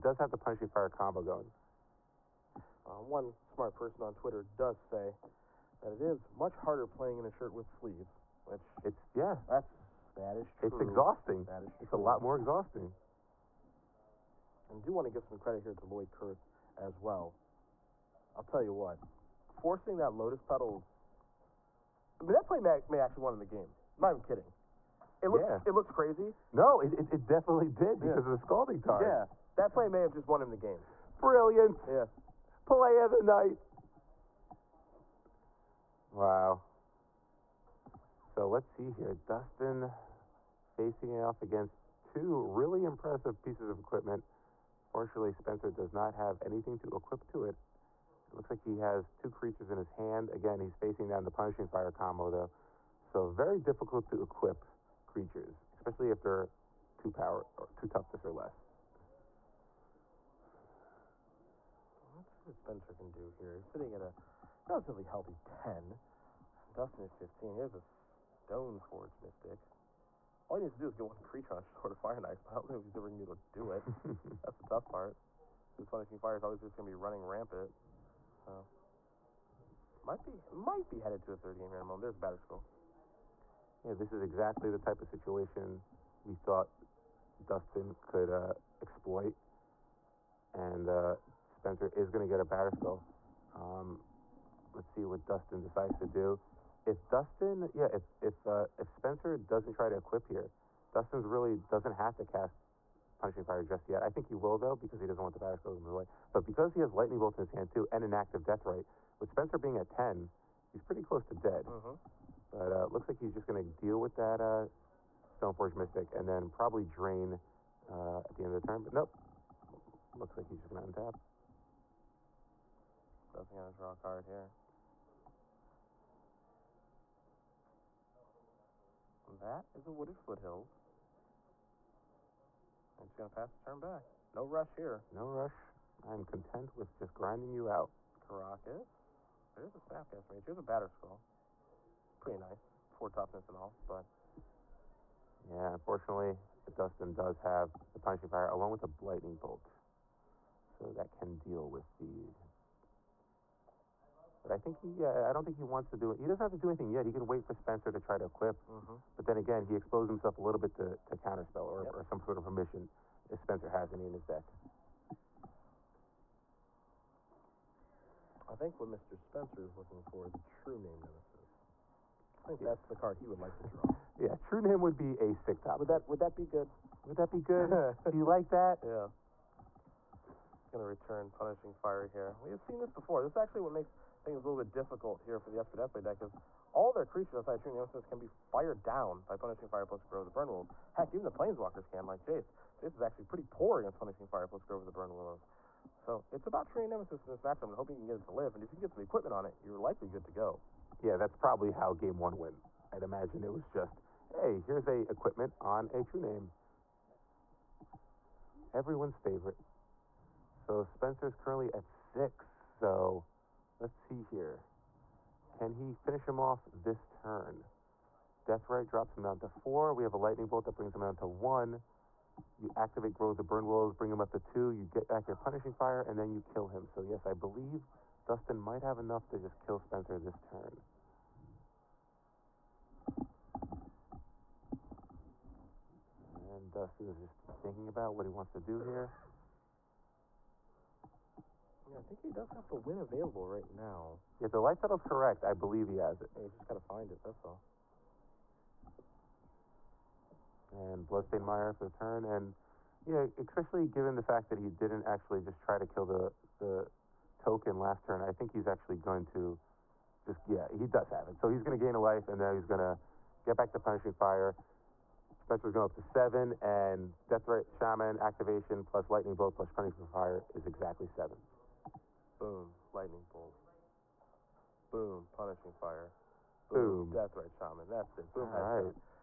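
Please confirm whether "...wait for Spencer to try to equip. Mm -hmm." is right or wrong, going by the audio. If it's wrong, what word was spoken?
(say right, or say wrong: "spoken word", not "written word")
right.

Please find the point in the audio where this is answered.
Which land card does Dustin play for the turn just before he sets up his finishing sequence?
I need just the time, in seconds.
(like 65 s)
251 s.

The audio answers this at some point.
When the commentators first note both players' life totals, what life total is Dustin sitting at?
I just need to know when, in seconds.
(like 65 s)
67 s.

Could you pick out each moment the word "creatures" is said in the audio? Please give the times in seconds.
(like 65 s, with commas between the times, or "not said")
49 s, 55 s, 71 s, 187 s.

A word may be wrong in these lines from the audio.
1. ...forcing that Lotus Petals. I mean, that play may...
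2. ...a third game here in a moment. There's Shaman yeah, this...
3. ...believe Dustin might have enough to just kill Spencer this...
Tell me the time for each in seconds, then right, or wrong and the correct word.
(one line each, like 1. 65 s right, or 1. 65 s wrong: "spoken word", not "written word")
1. 19 s right
2. 81 s wrong: "School", not "Shaman"
3. 227 s right.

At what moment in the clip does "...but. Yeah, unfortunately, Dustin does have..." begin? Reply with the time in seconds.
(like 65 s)
143 s.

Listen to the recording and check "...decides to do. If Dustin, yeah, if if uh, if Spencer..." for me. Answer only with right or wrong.
right.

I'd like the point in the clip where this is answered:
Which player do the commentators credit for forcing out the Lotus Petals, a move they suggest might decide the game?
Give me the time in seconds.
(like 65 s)
15 s.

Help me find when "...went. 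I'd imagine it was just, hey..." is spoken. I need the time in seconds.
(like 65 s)
202 s.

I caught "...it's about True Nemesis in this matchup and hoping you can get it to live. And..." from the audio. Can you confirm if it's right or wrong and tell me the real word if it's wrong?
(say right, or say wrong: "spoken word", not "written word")
right.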